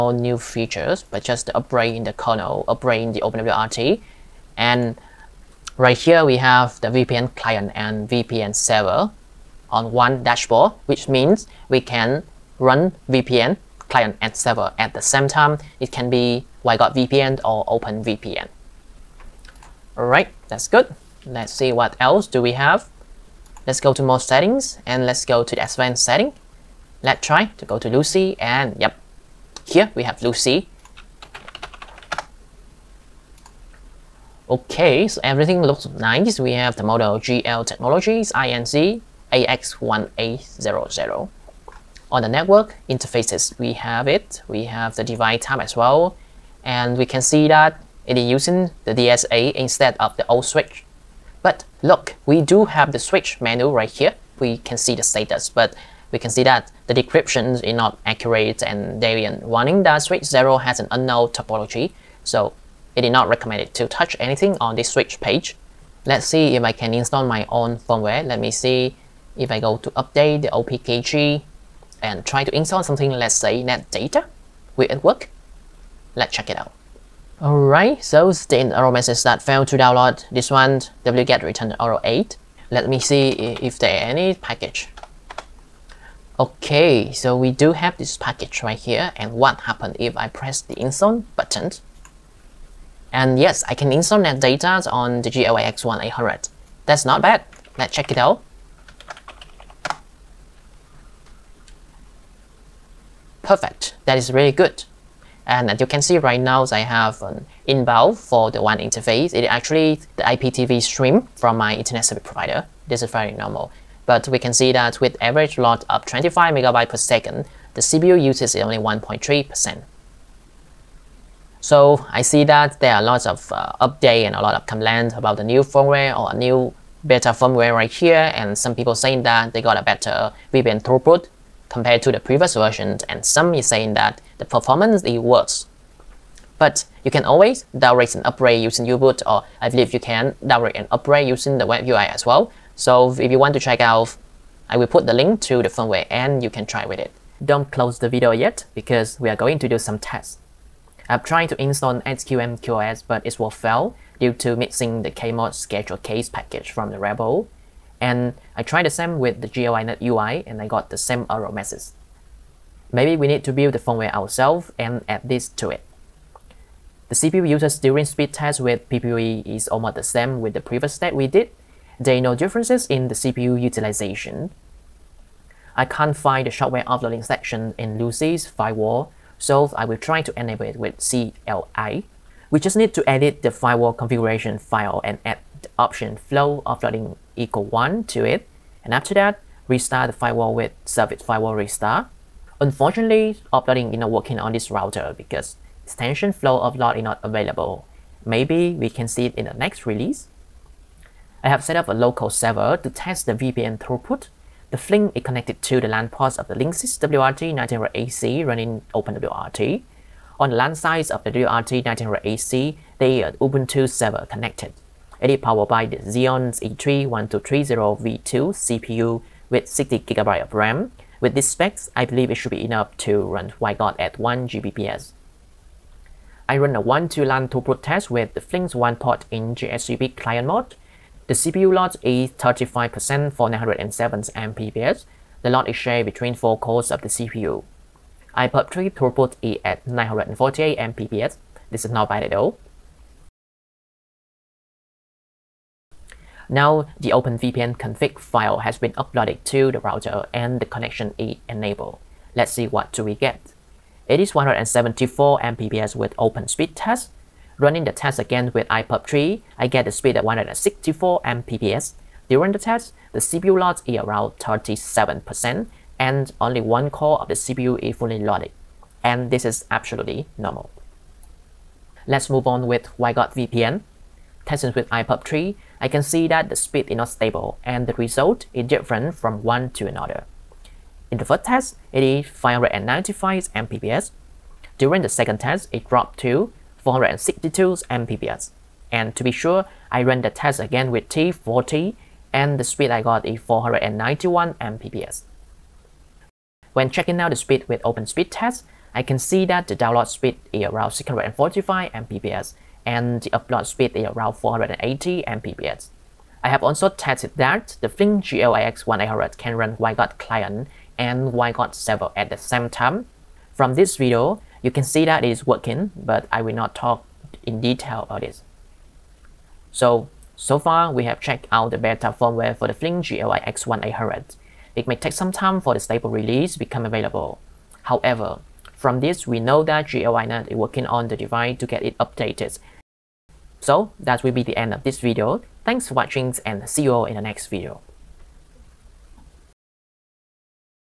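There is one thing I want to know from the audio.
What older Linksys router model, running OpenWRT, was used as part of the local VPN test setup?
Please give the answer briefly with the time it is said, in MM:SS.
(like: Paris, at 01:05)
WRT1900AC, at 03:26.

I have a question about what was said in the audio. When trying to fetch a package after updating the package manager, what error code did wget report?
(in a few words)
8.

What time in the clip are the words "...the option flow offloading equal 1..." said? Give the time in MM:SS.
03:05.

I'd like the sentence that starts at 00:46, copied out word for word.
And we can see that it is using the DSA instead of the old switch.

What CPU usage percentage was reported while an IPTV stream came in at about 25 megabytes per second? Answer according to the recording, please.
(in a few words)
1.3%.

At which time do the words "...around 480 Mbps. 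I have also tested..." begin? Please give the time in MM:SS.
05:04.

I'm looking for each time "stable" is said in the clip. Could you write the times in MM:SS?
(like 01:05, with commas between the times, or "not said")
04:37, 05:25.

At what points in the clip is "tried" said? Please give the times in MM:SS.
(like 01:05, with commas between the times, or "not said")
02:31, 02:38.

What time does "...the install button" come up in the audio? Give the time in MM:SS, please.
01:30.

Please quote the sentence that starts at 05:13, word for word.
From this video, you can see that it is working, but I will not talk in detail about this.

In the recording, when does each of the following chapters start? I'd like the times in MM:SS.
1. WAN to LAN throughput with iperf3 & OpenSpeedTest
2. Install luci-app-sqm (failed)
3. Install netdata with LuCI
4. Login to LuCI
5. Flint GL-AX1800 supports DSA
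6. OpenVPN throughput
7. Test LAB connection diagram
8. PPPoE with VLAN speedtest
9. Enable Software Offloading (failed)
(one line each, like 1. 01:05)
1. 03:46
2. 02:27
3. 01:05
4. 00:23
5. 00:41
6. 04:05
7. 03:21
8. 02:46
9. 02:55.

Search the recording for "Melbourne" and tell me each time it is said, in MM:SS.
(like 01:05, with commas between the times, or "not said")
not said.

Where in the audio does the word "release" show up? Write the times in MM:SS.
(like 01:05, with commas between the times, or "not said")
03:19, 05:26.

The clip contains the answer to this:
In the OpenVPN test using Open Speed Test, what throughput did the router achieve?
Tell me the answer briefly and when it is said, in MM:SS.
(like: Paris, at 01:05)
174 Mbps, at 04:14.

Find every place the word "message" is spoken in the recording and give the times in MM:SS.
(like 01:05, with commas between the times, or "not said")
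01:18, 02:41.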